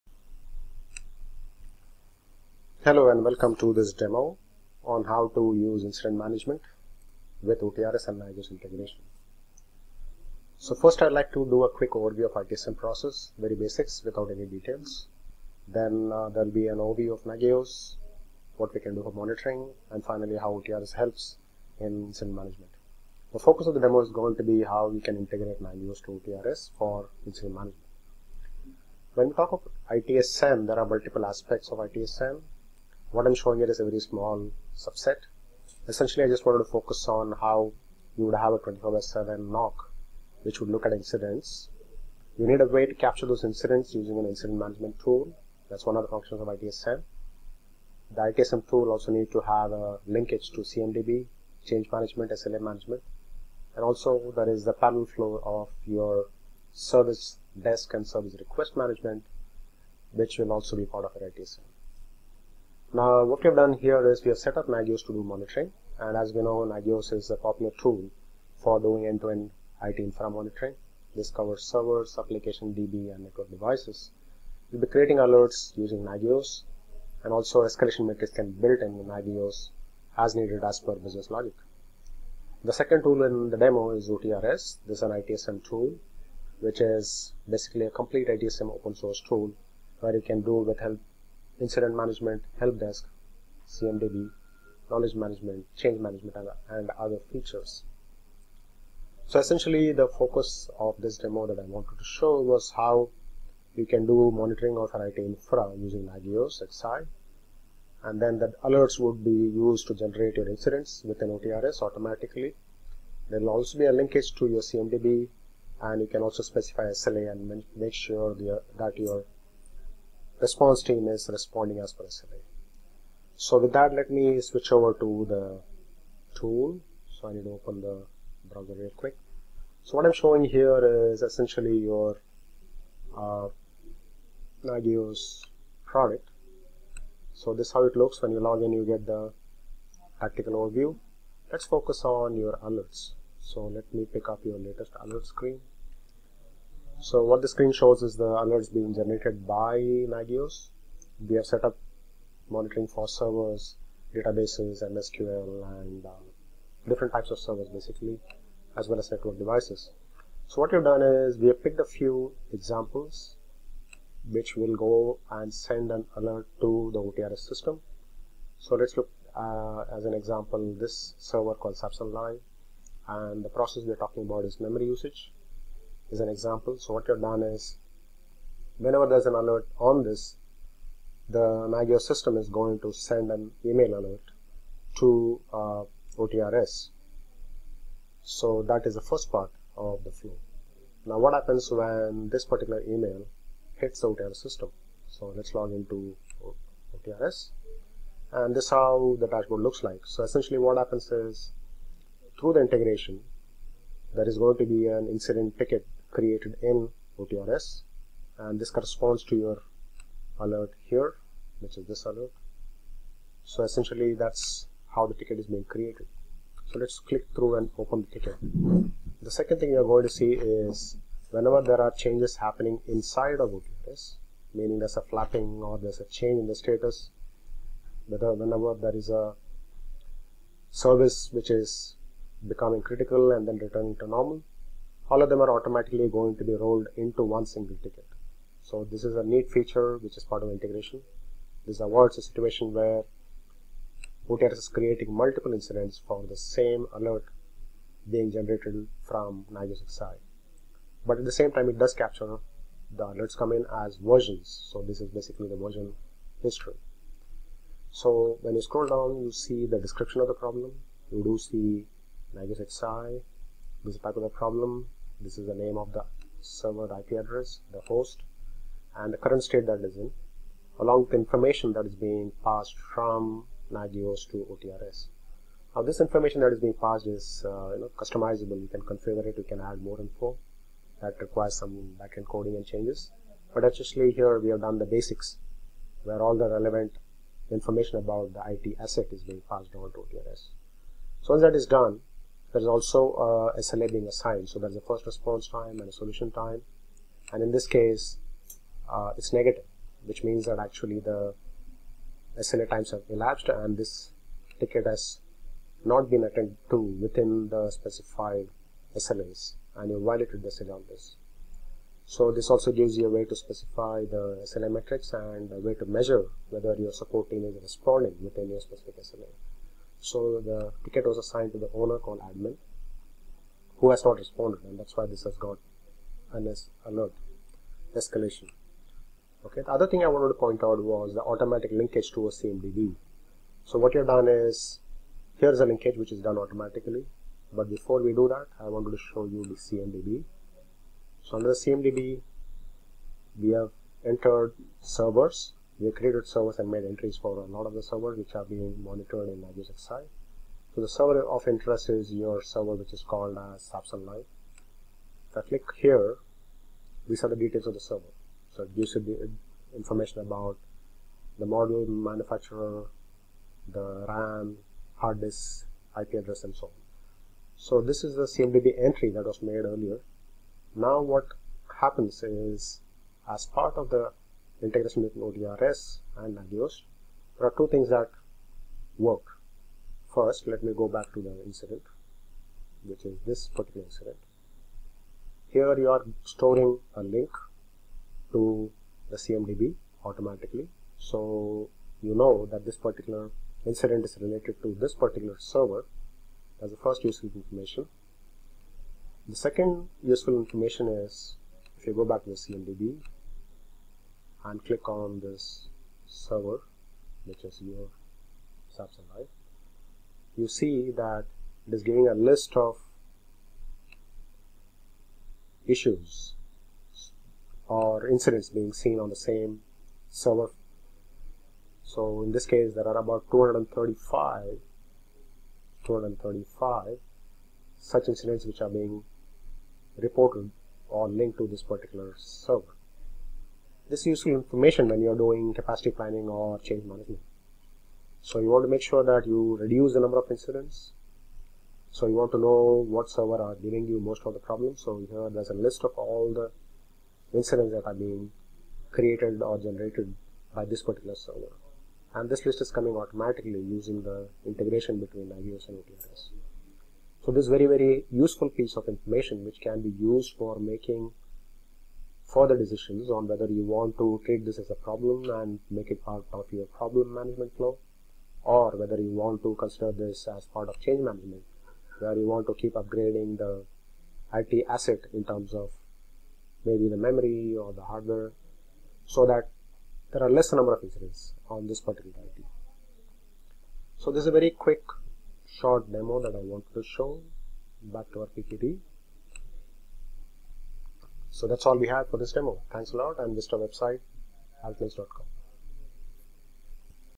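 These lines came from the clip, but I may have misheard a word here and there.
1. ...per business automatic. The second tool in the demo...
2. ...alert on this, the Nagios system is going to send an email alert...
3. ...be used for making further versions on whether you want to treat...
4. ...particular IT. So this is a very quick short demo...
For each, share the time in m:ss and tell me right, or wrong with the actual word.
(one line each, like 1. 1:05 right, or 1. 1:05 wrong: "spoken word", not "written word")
1. 1:20 wrong: "logic", not "automatic"
2. 2:59 right
3. 7:39 wrong: "decisions", not "versions"
4. 8:01 right.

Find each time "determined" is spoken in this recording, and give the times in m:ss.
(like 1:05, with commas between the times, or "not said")
not said.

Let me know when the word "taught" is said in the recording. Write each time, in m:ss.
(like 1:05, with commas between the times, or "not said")
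not said.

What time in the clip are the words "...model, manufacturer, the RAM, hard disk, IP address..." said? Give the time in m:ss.
6:01.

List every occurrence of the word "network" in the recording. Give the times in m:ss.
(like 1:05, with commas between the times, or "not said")
1:13, 2:39.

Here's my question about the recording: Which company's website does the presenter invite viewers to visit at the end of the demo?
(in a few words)
altnix.com.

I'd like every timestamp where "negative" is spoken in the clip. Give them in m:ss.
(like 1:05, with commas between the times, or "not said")
4:59.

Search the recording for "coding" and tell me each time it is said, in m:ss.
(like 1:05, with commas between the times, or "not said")
4:42.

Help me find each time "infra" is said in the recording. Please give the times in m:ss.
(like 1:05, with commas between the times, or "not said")
1:09, 1:45.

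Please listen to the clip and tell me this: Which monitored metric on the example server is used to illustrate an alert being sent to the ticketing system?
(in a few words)
memory usage.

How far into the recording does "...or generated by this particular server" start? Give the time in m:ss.
7:29.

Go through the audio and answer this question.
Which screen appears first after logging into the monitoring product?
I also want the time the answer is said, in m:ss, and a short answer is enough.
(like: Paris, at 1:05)
tactical overview, at 2:20.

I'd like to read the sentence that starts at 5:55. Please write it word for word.
If I click here, these are the details of the server.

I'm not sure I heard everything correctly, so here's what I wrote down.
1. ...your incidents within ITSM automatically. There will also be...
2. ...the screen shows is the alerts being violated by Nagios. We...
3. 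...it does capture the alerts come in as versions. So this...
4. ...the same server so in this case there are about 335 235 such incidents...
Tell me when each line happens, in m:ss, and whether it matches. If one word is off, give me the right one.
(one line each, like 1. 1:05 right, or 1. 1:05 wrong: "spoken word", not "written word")
1. 1:50 wrong: "OTRS", not "ITSM"
2. 2:27 wrong: "generated", not "violated"
3. 4:11 right
4. 6:59 wrong: "235", not "335".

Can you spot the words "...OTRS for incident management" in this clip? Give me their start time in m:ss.
0:26.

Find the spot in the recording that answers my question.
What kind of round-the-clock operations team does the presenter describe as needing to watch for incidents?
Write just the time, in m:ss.
0:38.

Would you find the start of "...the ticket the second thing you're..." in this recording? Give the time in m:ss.
3:38.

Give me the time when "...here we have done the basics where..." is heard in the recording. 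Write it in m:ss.
4:44.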